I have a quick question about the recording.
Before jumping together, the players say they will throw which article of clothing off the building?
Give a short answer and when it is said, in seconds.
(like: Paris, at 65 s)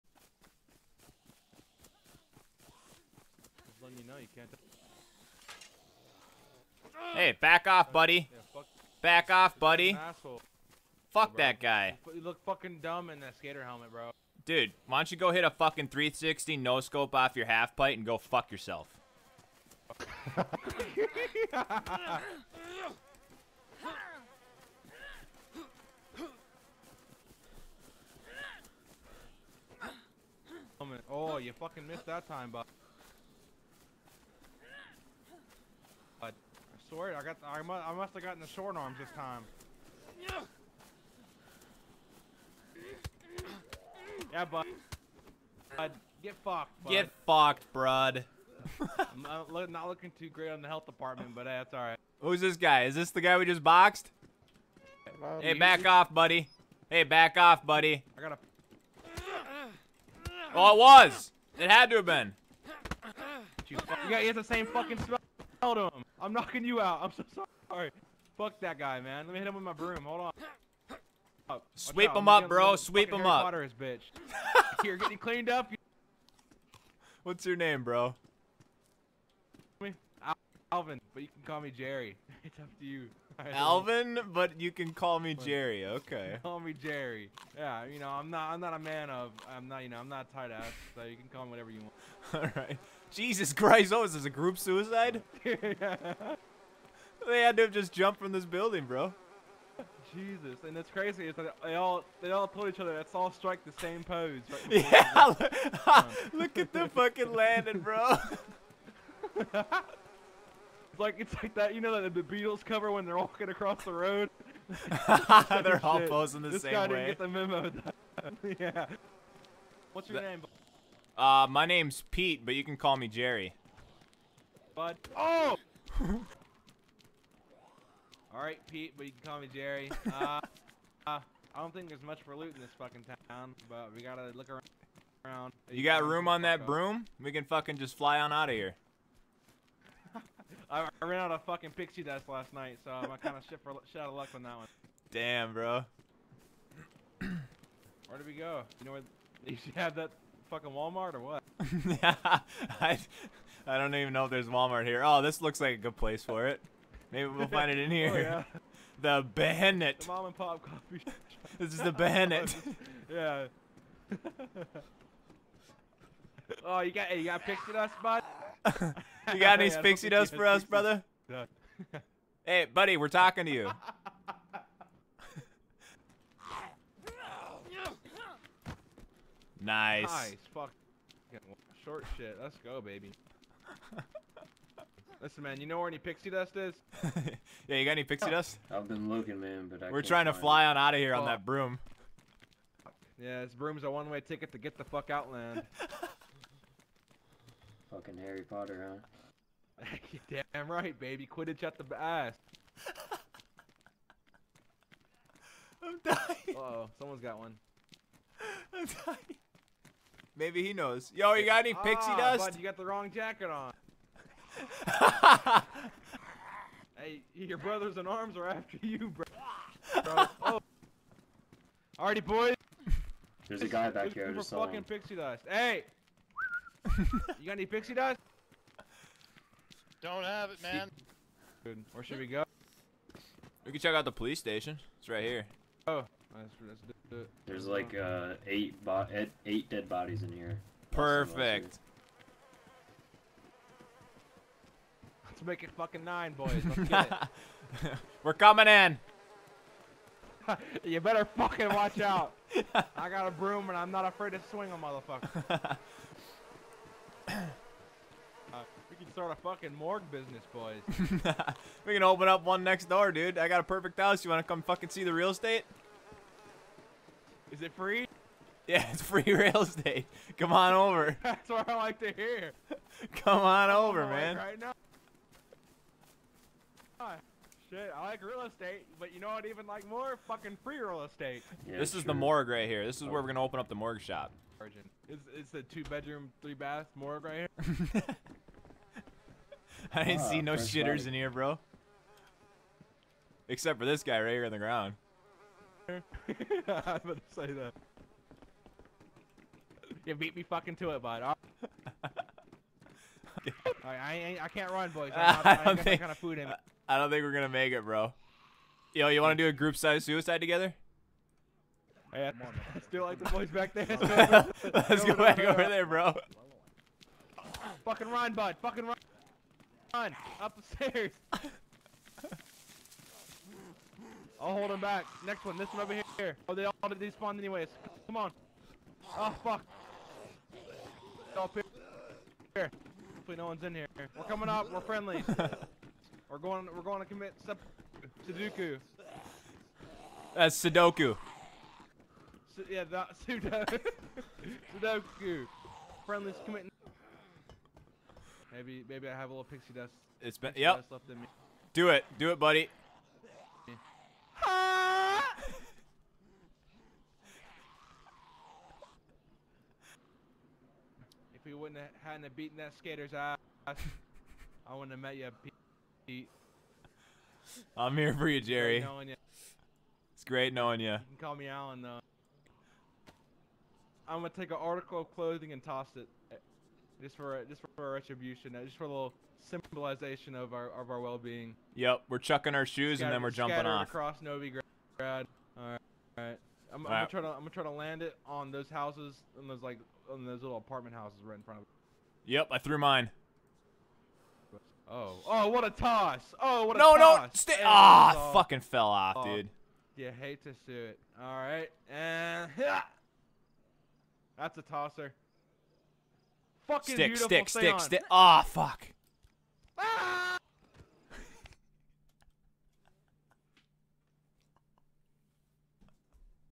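Shoes, at 382 s.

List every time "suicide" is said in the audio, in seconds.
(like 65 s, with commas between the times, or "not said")
94 s, 310 s.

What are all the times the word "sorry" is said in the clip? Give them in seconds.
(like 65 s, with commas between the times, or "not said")
36 s, 67 s.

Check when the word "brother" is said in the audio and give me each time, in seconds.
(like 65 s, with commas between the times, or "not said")
170 s, 217 s.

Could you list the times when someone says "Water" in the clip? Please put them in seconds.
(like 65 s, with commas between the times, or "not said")
73 s.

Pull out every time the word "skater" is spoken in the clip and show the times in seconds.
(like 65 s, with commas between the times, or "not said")
13 s, 362 s.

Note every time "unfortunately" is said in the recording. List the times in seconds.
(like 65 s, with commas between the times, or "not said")
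not said.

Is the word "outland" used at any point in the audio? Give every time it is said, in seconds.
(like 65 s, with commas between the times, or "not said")
195 s.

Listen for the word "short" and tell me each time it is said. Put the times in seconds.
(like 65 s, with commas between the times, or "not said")
38 s, 181 s.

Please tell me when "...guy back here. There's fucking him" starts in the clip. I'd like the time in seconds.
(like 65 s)
223 s.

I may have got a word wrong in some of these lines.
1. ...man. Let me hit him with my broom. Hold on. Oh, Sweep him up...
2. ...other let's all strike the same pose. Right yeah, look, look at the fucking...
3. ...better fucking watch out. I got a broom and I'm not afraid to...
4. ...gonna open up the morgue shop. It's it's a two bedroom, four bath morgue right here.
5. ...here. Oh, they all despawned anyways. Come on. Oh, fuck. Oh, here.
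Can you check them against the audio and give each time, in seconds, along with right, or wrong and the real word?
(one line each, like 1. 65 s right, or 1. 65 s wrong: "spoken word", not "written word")
1. 68 s right
2. 102 s right
3. 250 s right
4. 283 s wrong: "three", not "four"
5. 326 s right.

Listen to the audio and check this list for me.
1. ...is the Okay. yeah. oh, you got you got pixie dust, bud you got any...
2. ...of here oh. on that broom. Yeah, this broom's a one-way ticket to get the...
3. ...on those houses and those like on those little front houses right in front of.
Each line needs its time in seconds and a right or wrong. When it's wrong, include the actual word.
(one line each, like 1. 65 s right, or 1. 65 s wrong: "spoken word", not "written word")
1. 161 s wrong: "Behenet", not "Okay"
2. 190 s right
3. 388 s wrong: "apartment", not "front".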